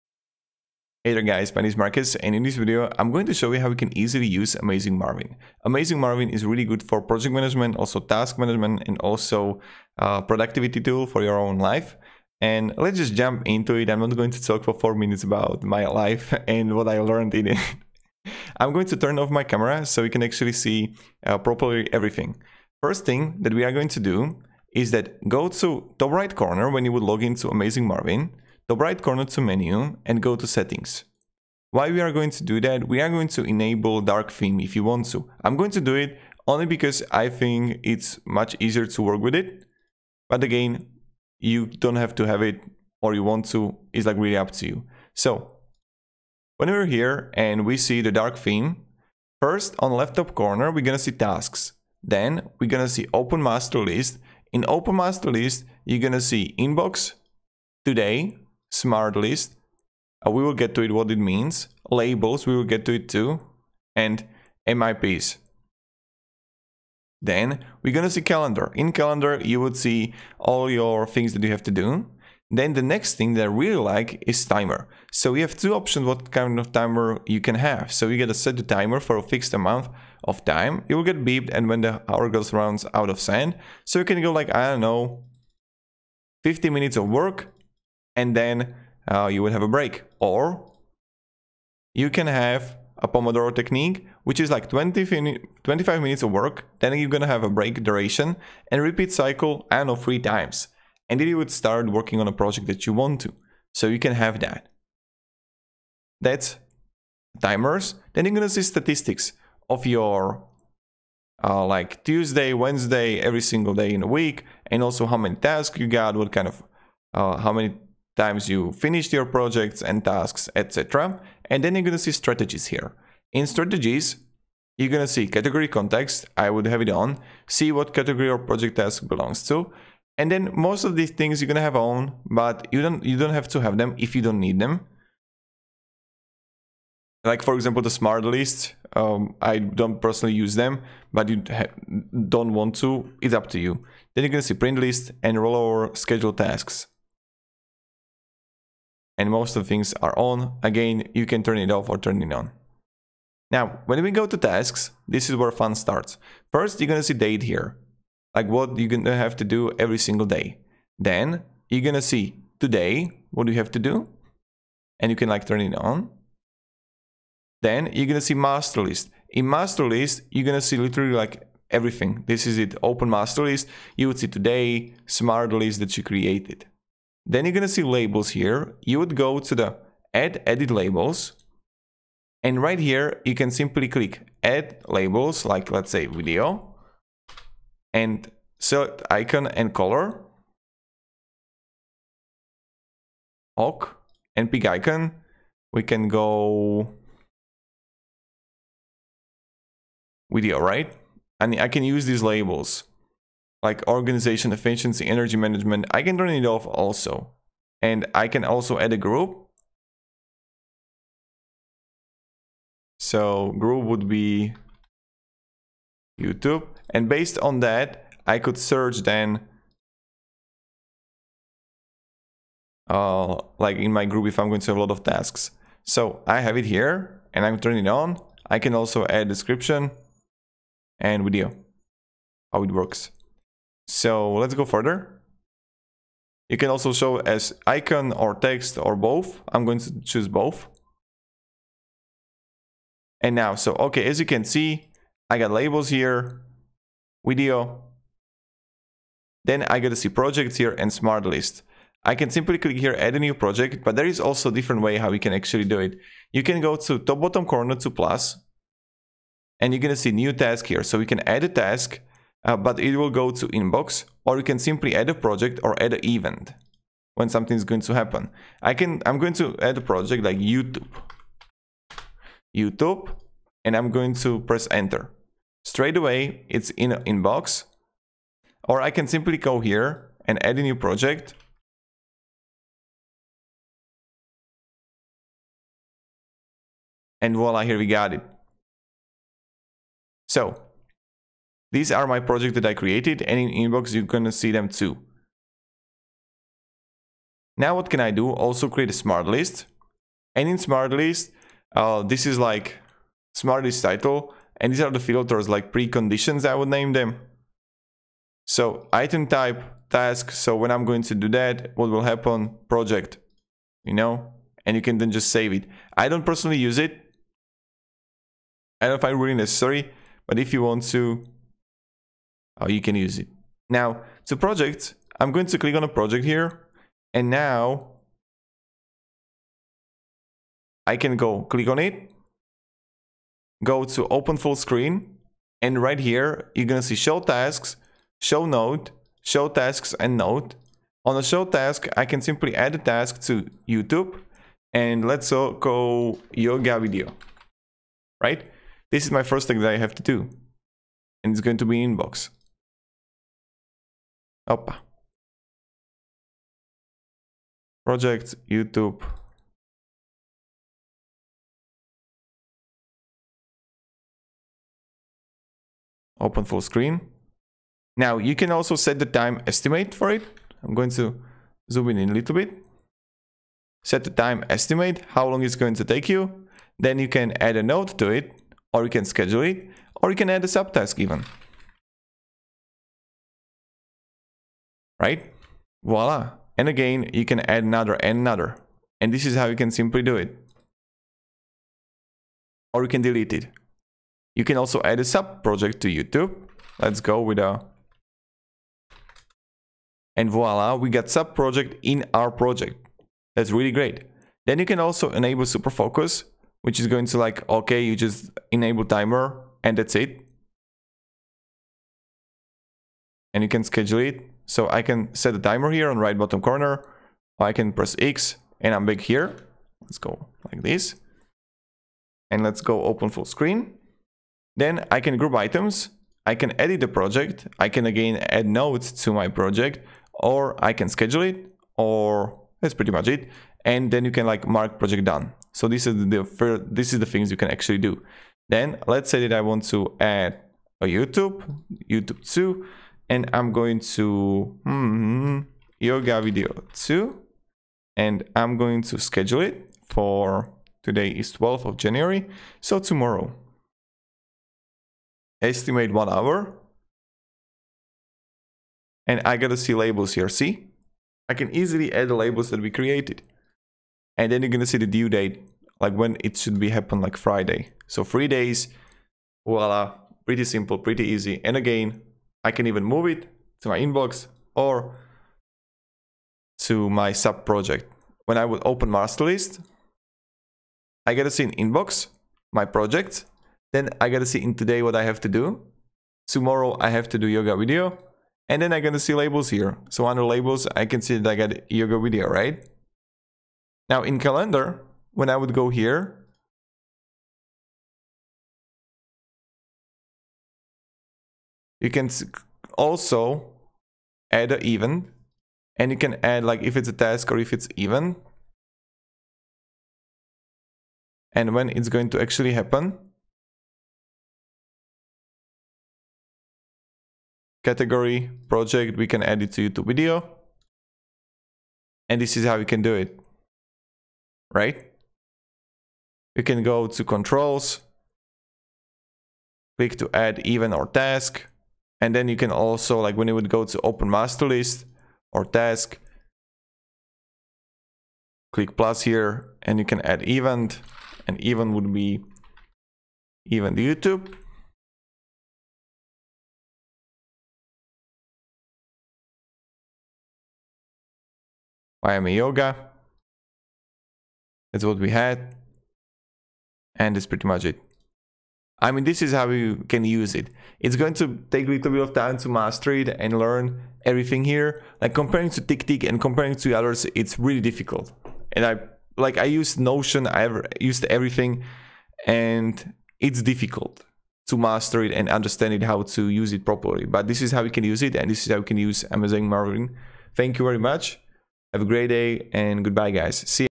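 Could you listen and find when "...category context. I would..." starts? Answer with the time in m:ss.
2:05.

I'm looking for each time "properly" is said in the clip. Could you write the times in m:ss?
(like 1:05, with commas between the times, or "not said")
0:21, 9:36.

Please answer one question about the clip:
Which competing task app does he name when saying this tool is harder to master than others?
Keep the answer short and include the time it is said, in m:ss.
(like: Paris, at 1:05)
TickTick, at 9:25.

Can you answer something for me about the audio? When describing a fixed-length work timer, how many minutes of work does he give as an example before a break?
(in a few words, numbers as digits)
50.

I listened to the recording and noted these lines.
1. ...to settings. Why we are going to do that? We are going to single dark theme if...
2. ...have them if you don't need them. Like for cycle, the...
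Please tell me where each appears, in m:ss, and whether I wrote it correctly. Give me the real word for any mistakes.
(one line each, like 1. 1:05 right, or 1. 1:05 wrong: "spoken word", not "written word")
1. 0:30 wrong: "enable", not "single"
2. 2:13 wrong: "example", not "cycle".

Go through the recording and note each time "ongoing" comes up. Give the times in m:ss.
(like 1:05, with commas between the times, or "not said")
not said.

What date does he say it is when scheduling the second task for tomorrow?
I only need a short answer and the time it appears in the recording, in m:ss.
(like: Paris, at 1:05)
12th of January, at 7:31.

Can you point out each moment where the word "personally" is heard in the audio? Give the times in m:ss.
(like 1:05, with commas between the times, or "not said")
2:20, 5:16.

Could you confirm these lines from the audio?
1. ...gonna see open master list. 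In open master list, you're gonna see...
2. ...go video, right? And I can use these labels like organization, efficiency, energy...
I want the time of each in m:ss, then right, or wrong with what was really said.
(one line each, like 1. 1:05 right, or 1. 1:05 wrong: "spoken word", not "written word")
1. 0:52 right
2. 3:16 right.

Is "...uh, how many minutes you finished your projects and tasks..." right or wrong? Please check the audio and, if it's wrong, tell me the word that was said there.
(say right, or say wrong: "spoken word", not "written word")
wrong: "times", not "minutes".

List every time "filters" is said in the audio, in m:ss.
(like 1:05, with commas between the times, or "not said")
5:04.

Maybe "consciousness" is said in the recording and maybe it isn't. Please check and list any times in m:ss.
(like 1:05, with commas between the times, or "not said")
not said.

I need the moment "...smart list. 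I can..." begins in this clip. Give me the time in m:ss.
4:10.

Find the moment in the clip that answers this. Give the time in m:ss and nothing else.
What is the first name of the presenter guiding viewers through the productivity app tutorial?
0:01.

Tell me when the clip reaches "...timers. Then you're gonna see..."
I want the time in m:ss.
1:47.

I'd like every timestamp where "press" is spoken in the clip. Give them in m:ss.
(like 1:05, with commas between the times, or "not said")
4:34, 6:57.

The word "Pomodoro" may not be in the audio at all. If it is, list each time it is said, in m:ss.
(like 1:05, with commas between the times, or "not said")
1:33.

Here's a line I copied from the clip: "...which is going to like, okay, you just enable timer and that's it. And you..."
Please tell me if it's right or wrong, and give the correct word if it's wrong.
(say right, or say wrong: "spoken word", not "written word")
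right.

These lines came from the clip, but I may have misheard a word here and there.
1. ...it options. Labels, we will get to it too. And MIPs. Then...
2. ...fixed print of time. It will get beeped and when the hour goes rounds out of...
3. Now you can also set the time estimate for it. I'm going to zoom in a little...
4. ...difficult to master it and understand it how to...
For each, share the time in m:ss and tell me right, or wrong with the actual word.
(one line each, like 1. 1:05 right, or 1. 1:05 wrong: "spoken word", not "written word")
1. 1:01 wrong: "means", not "options"
2. 1:19 wrong: "amount", not "print"
3. 6:07 right
4. 9:33 right.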